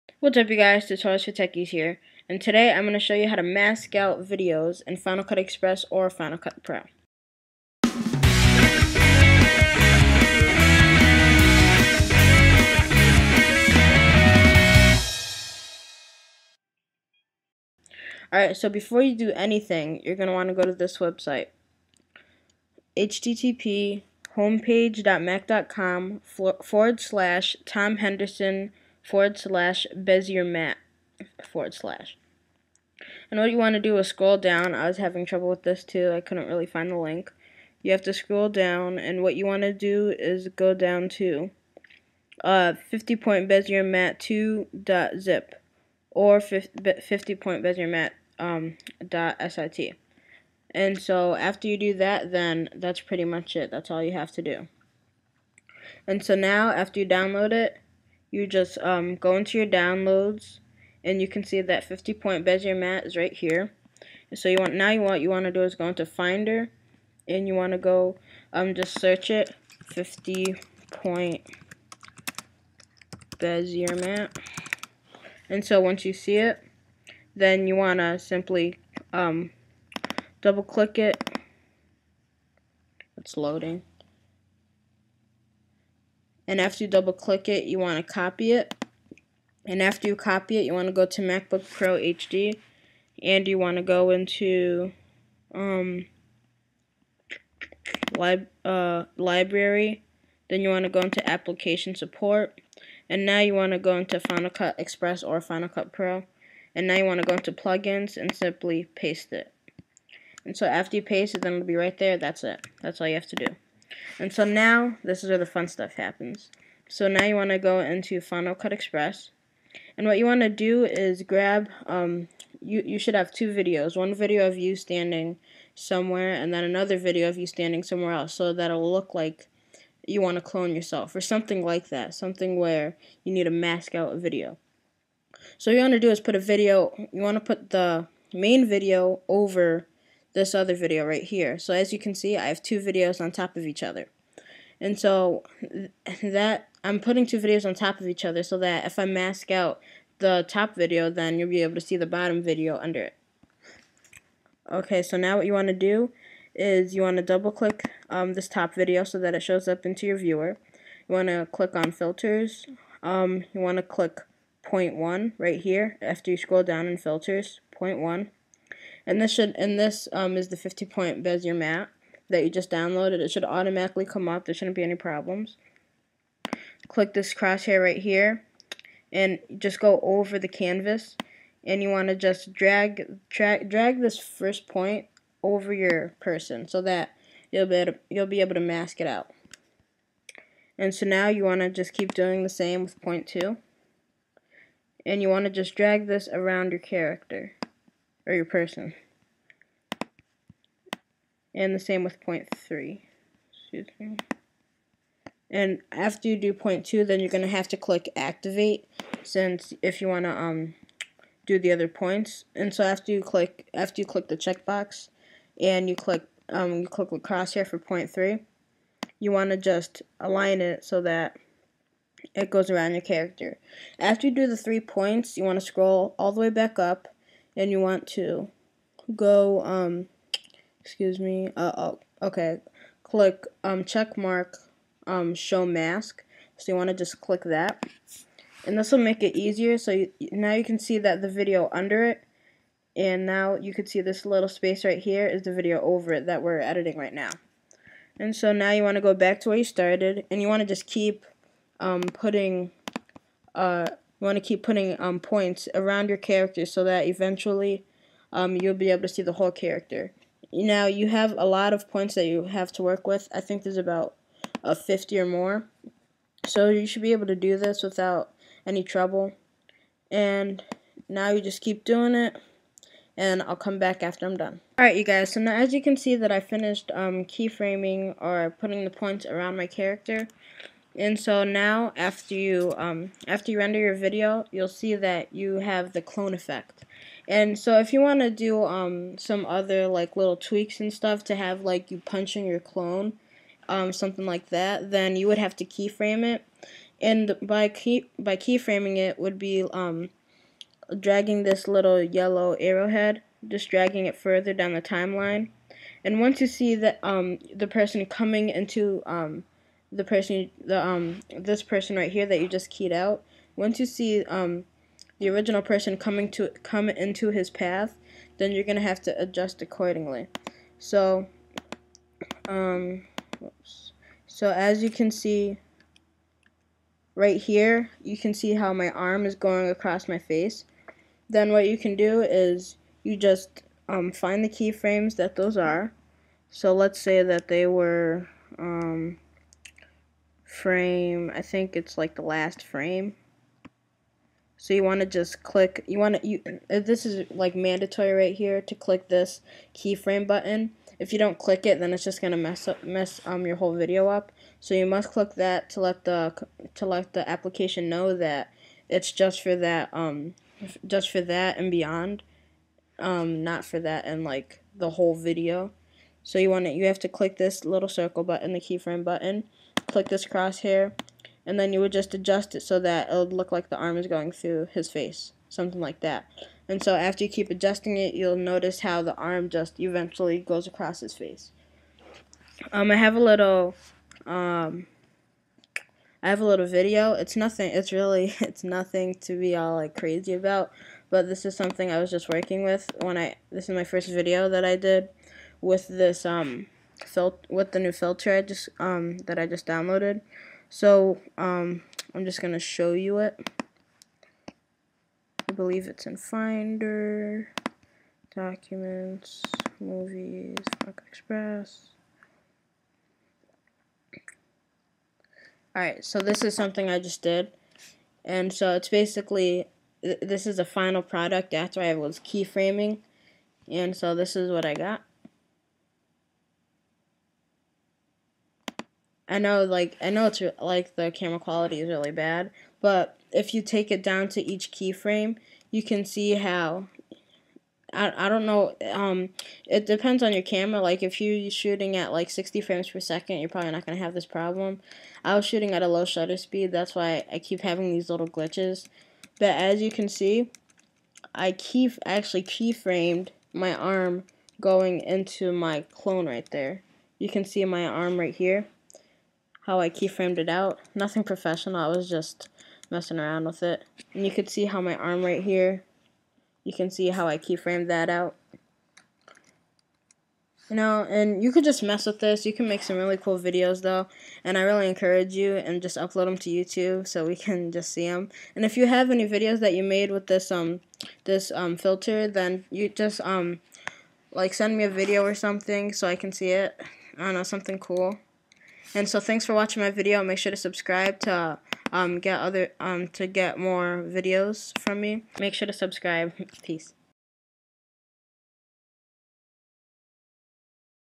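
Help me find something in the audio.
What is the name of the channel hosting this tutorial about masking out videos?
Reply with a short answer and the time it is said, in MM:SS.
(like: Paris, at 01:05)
Tutorials for Techies, at 00:00.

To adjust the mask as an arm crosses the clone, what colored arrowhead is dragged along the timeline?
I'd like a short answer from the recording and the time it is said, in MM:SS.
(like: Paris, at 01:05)
yellow, at 05:02.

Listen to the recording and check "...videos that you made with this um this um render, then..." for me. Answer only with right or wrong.
wrong.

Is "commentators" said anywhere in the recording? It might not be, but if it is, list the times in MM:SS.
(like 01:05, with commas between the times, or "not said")
not said.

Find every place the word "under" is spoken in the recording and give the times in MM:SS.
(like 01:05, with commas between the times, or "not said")
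02:32, 04:01.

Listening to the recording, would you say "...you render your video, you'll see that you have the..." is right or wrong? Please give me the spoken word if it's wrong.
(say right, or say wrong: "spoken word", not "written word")
right.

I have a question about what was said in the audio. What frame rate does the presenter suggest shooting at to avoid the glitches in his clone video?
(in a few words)
60 frames per second.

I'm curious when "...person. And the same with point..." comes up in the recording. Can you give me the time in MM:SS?
03:18.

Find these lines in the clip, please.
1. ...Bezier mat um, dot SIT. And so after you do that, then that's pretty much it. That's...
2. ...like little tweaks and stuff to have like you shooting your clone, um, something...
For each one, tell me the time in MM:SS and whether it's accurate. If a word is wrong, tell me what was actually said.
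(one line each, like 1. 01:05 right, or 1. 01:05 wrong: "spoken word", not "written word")
1. 00:47 right
2. 04:49 wrong: "punching", not "shooting".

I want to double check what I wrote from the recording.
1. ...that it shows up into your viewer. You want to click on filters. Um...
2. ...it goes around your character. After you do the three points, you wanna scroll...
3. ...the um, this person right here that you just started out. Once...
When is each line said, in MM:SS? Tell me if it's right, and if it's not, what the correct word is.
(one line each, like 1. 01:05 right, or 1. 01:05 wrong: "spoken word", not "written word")
1. 02:39 right
2. 03:42 right
3. 05:10 wrong: "keyed", not "started".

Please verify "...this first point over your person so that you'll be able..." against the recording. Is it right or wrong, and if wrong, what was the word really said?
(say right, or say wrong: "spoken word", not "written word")
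right.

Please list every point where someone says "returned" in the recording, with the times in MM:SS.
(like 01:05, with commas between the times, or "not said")
not said.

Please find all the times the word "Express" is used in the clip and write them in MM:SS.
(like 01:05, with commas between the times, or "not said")
00:05, 01:44, 01:58, 06:51.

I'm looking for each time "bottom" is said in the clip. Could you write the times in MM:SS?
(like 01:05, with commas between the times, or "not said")
02:32.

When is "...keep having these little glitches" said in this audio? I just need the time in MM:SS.
07:27.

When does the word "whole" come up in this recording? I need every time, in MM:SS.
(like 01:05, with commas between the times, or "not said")
04:19, 05:53, 06:04.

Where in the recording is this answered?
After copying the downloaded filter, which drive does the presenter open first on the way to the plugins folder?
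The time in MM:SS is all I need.
01:31.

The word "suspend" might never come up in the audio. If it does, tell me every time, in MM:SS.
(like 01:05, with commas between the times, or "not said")
not said.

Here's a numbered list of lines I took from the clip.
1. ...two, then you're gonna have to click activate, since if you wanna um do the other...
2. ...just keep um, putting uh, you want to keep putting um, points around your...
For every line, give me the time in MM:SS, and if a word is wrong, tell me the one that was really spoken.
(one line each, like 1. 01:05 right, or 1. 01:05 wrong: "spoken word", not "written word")
1. 03:26 right
2. 04:10 right.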